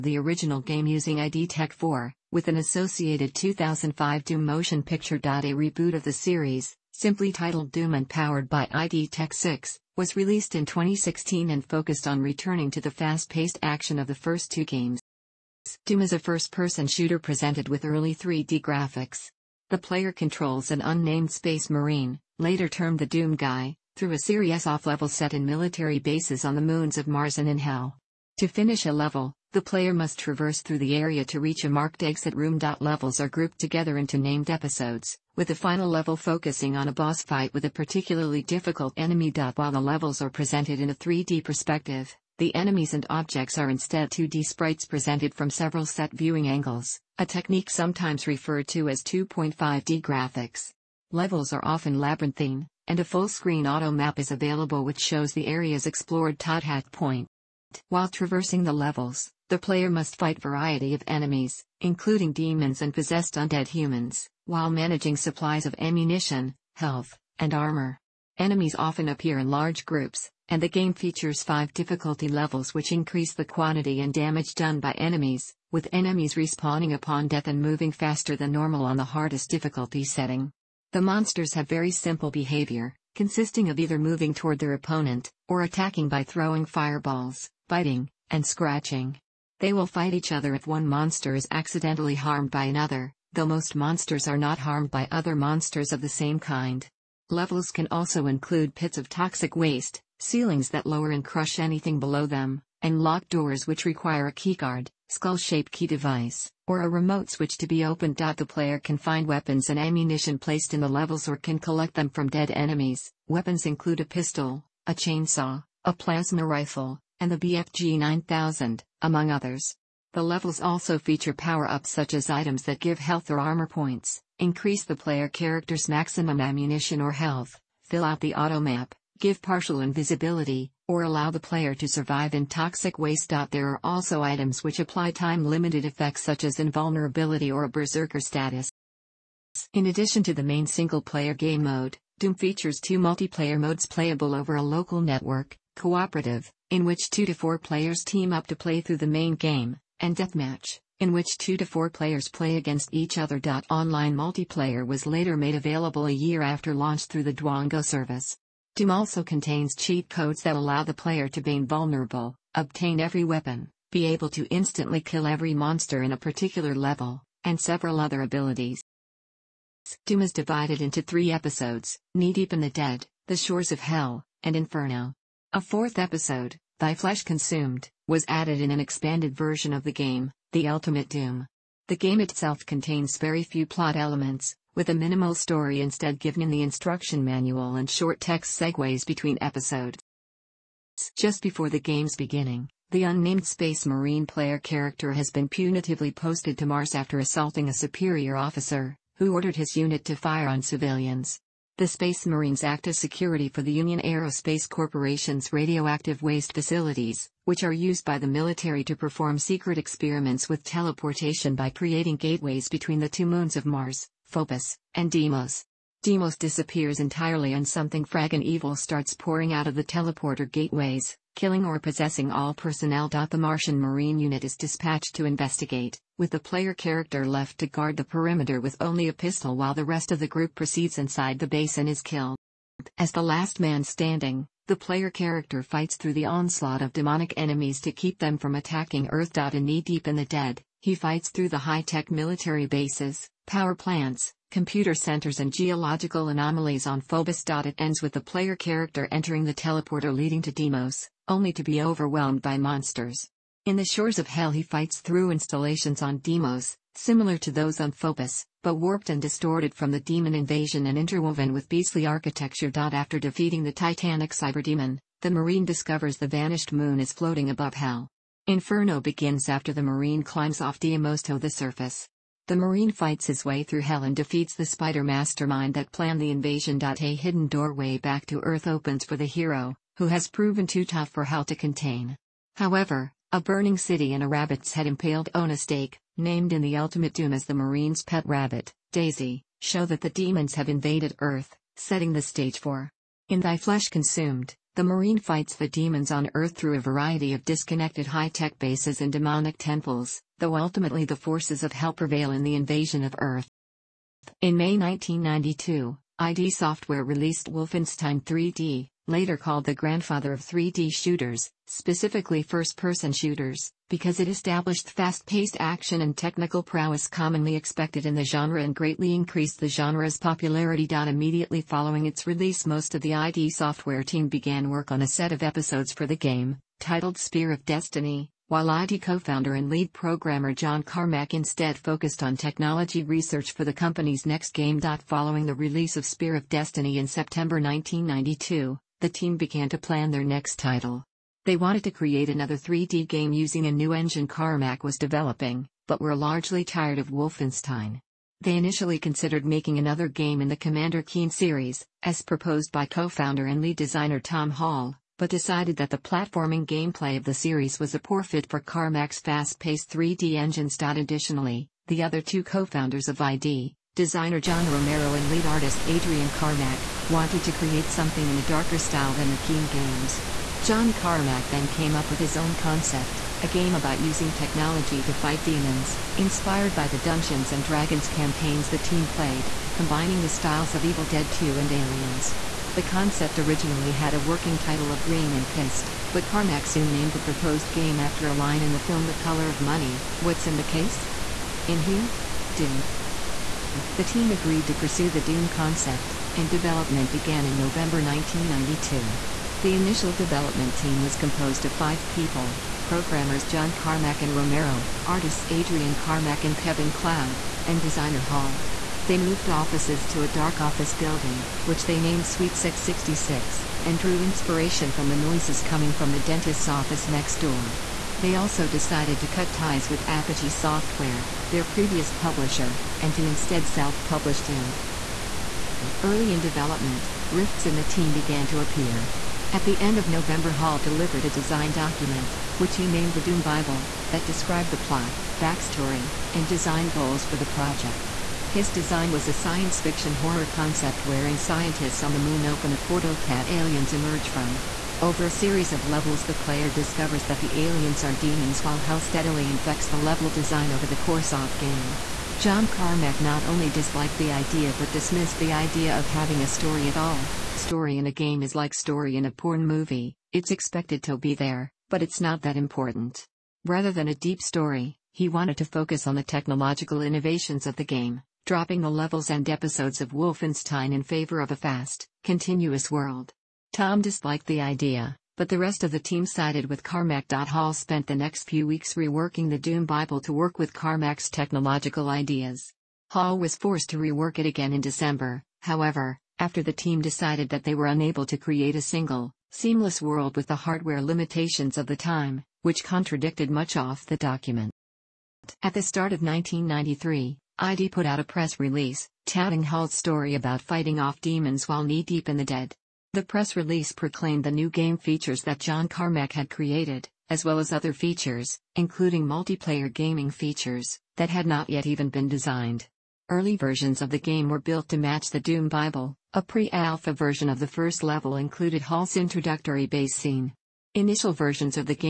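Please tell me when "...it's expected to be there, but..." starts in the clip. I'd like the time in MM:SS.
07:40.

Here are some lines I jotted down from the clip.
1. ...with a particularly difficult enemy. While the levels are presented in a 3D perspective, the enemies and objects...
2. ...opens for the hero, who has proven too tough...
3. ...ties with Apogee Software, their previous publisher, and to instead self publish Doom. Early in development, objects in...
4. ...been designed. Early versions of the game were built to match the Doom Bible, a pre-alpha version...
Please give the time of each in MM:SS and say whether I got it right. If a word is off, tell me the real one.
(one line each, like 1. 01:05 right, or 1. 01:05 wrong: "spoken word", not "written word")
1. 00:37 right
2. 04:38 right
3. 06:59 wrong: "rifts", not "objects"
4. 08:32 right.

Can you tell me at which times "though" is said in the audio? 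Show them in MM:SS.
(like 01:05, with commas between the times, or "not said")
01:33, 05:00.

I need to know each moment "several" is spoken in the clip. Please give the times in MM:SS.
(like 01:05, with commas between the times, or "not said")
00:45, 02:47.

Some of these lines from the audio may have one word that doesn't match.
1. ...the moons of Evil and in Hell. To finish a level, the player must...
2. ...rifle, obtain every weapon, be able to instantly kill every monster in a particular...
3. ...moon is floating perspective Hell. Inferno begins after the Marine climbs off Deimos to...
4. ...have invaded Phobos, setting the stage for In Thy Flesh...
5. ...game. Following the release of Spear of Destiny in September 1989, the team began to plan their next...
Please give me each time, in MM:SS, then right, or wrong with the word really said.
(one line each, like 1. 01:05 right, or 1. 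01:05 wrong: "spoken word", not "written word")
1. 00:26 wrong: "Mars", not "Evil"
2. 02:41 wrong: "invulnerable", not "rifle"
3. 04:26 wrong: "above", not "perspective"
4. 04:50 wrong: "Earth", not "Phobos"
5. 05:34 wrong: "1992", not "1989".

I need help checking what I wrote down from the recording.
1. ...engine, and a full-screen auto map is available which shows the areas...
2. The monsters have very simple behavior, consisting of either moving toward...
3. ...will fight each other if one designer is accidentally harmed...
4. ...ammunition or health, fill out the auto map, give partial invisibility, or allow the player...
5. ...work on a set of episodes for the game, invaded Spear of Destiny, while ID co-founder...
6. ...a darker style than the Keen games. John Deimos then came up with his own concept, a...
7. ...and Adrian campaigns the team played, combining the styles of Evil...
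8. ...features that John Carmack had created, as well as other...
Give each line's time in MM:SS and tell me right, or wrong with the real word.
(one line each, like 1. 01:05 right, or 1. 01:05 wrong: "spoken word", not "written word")
1. 00:51 wrong: "labyrinthine", not "engine"
2. 01:20 right
3. 01:29 wrong: "monster", not "designer"
4. 02:06 right
5. 05:24 wrong: "titled", not "invaded"
6. 06:08 wrong: "Carmack", not "Deimos"
7. 06:17 wrong: "Dragons", not "Adrian"
8. 08:24 right.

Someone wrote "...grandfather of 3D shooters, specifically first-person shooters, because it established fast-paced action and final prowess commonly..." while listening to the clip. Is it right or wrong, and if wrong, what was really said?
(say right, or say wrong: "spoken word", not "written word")
wrong: "technical", not "final".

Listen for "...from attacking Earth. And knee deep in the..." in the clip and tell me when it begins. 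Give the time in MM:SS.
03:58.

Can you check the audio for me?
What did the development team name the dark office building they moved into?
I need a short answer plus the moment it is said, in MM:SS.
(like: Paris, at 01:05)
Suite 666, at 06:52.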